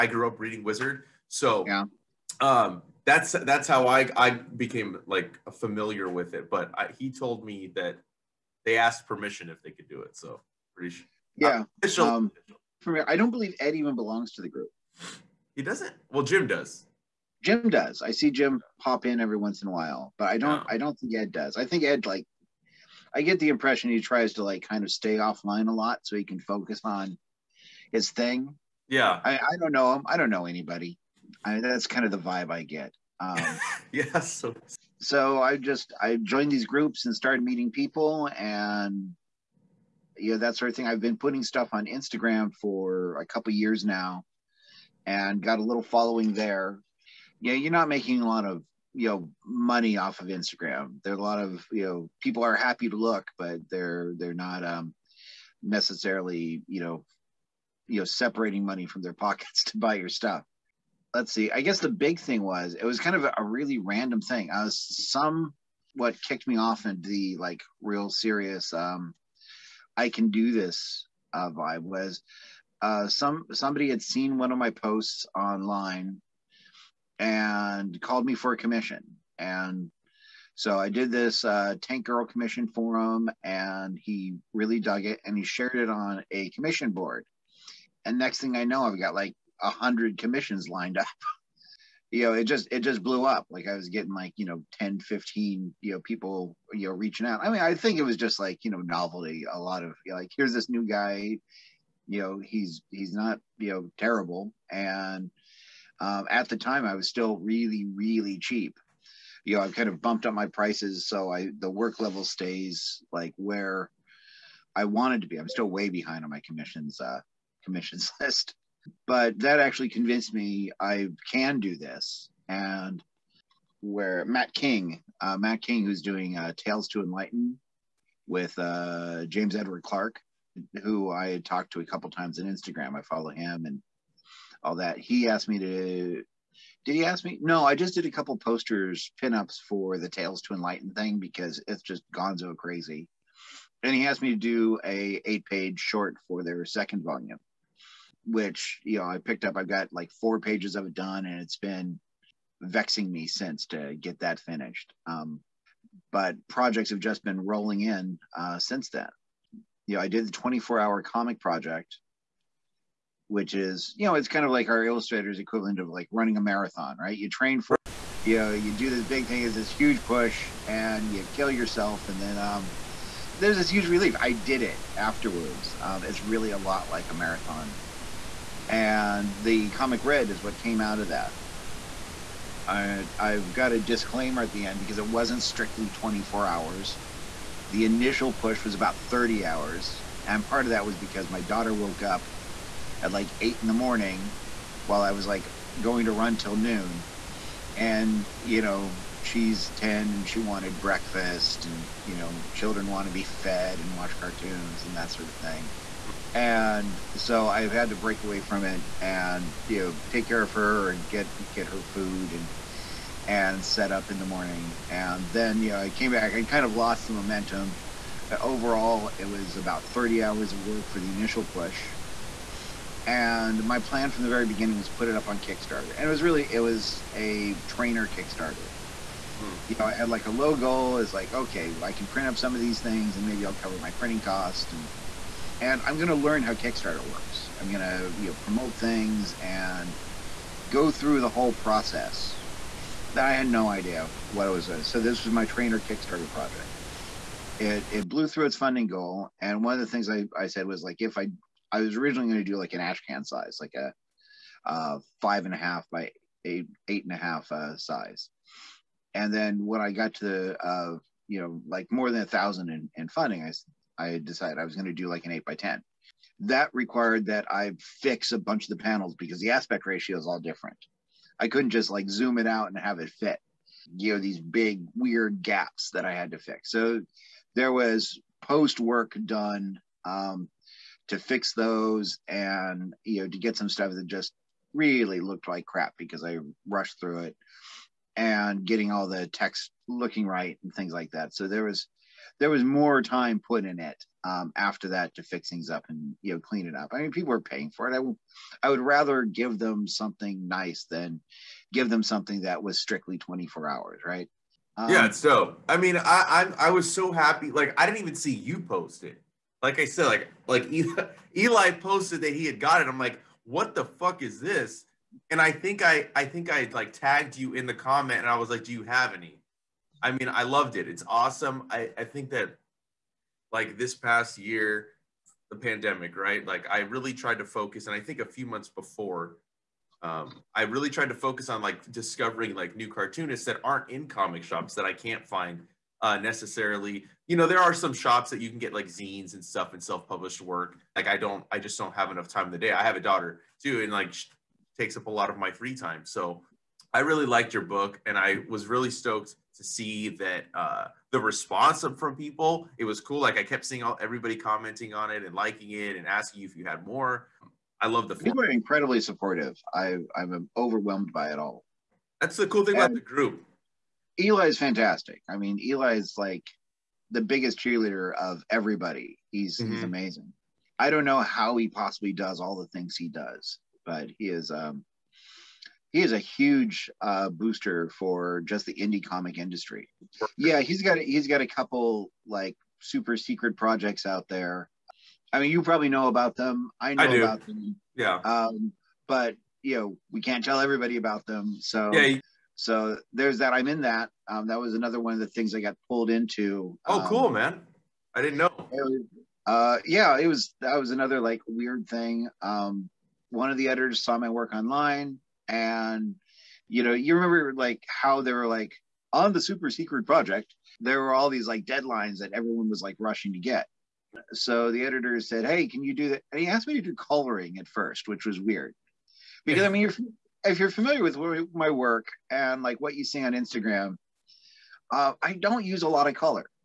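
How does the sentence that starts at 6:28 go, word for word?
Um, but you know, we can't tell everybody about them.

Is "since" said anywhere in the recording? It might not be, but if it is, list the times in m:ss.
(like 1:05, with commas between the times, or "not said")
2:33, 2:38.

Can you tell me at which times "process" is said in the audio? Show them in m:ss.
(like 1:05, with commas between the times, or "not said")
4:01.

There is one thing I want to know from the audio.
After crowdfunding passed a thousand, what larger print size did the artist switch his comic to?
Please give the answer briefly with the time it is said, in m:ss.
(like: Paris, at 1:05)
8 by 10, at 4:25.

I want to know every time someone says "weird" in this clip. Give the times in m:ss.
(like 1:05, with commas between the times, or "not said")
4:34, 6:41, 6:58.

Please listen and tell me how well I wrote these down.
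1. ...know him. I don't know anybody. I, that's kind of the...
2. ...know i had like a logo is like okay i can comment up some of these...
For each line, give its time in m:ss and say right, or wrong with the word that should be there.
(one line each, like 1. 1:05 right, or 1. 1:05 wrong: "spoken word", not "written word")
1. 0:29 right
2. 3:49 wrong: "print", not "comment".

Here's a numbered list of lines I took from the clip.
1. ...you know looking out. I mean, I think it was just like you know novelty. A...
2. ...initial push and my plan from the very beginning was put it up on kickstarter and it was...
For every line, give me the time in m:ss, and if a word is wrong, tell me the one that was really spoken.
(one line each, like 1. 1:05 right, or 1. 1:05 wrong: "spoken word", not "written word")
1. 1:36 wrong: "reaching", not "looking"
2. 3:41 right.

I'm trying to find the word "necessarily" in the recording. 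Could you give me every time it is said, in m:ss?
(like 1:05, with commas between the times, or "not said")
0:55, 5:36.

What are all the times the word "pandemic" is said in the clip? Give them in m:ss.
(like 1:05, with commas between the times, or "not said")
5:25.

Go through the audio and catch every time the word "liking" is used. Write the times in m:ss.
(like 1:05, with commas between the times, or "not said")
5:55.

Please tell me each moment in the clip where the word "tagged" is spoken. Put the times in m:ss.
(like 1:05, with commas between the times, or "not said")
5:16.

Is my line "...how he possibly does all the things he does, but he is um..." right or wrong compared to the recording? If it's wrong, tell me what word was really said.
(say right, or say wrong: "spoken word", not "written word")
right.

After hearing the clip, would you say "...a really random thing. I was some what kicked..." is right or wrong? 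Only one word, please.
right.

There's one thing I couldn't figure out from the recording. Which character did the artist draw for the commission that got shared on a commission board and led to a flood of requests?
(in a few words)
Tank Girl.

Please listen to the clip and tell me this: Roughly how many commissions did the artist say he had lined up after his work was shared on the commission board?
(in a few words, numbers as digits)
100.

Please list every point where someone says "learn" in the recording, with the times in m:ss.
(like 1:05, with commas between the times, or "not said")
3:56.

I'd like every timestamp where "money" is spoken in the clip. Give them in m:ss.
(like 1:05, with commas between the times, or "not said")
0:49, 0:58.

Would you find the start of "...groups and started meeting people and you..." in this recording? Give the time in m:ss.
0:36.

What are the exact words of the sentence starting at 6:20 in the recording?
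Yeah, he's got a, he's got a couple like super secret projects out there.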